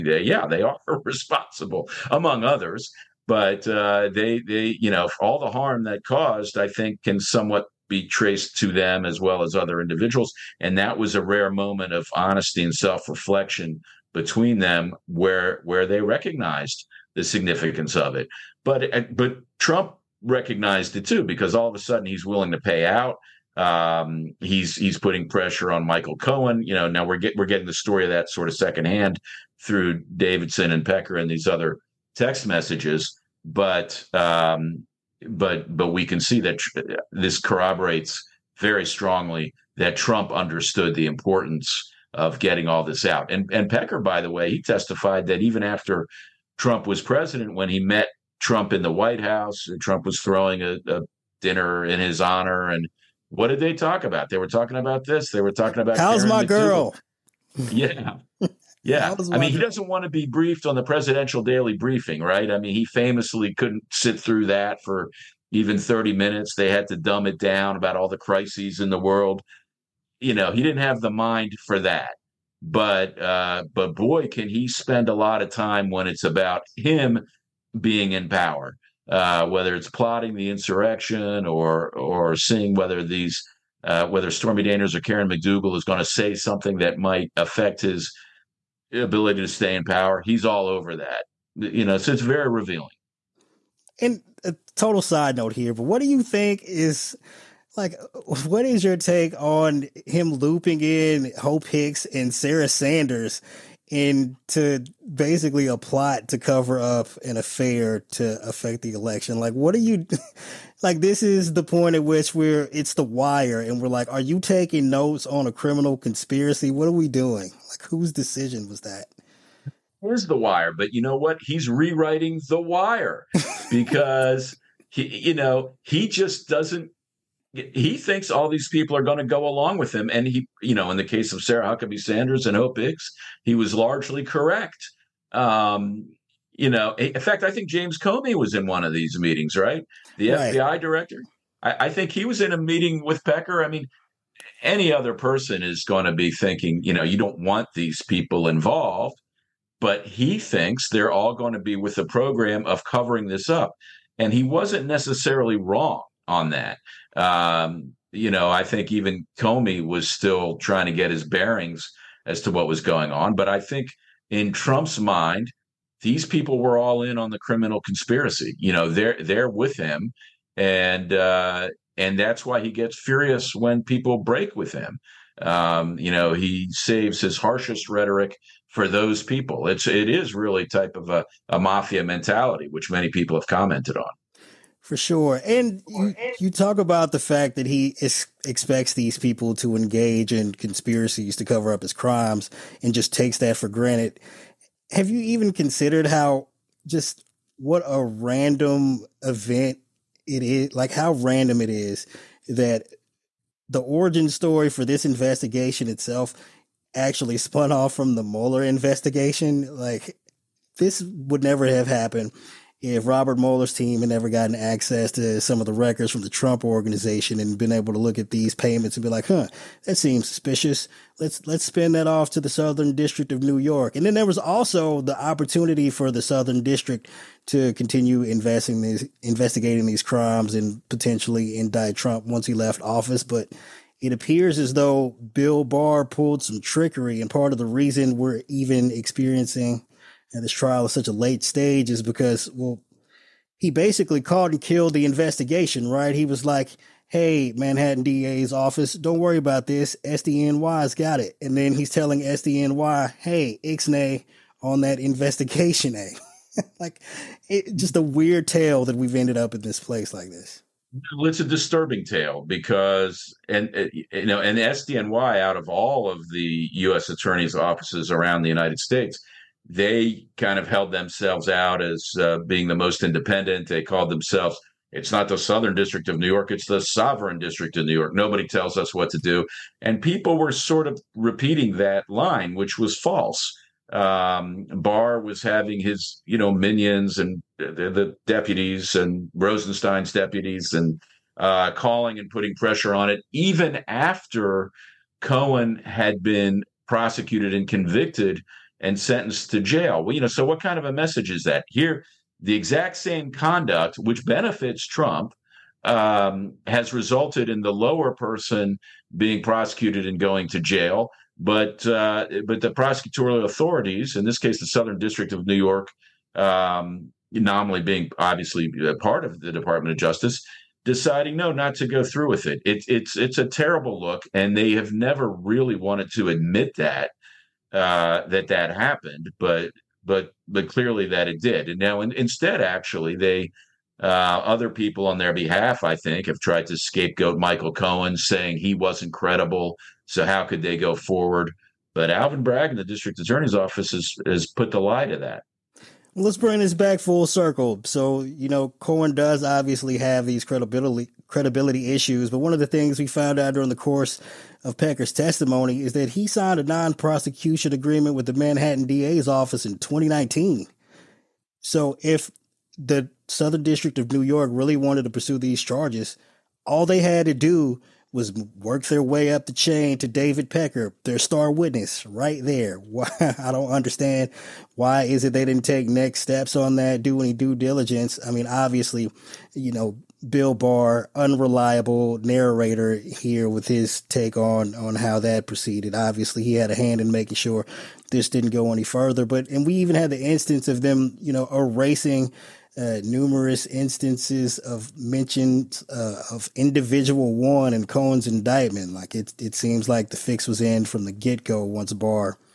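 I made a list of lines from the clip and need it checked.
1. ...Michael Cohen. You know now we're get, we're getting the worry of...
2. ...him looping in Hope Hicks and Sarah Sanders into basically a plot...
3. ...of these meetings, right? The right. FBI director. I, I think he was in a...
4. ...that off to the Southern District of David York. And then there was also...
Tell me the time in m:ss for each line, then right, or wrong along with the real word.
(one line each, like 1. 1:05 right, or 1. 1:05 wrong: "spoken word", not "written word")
1. 0:25 wrong: "story", not "worry"
2. 1:40 right
3. 2:18 right
4. 3:41 wrong: "New", not "David".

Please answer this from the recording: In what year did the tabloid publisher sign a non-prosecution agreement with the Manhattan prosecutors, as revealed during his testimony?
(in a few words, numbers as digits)
2019.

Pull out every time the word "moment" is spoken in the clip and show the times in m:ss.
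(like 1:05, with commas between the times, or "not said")
0:11.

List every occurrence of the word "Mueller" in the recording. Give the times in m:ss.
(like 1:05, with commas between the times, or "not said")
3:28, 3:33.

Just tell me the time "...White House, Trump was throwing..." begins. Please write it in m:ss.
0:48.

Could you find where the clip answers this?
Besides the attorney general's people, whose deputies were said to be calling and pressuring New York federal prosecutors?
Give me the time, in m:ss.
4:49.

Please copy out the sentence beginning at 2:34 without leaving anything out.
And he wasn't necessarily wrong on that.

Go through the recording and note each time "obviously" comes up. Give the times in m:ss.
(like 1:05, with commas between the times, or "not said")
5:18, 5:49, 6:18, 6:25.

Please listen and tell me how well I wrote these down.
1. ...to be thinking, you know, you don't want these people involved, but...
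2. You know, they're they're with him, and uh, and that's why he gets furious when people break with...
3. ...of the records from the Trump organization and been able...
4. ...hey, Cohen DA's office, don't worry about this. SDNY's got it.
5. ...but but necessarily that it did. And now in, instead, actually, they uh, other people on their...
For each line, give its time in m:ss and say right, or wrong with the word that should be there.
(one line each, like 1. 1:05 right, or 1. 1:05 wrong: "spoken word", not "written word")
1. 2:26 right
2. 2:48 right
3. 3:35 right
4. 4:07 wrong: "Manhattan", not "Cohen"
5. 5:30 wrong: "clearly", not "necessarily".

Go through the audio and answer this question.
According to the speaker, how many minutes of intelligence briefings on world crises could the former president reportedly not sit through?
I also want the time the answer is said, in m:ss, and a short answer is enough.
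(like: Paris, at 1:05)
30, at 1:05.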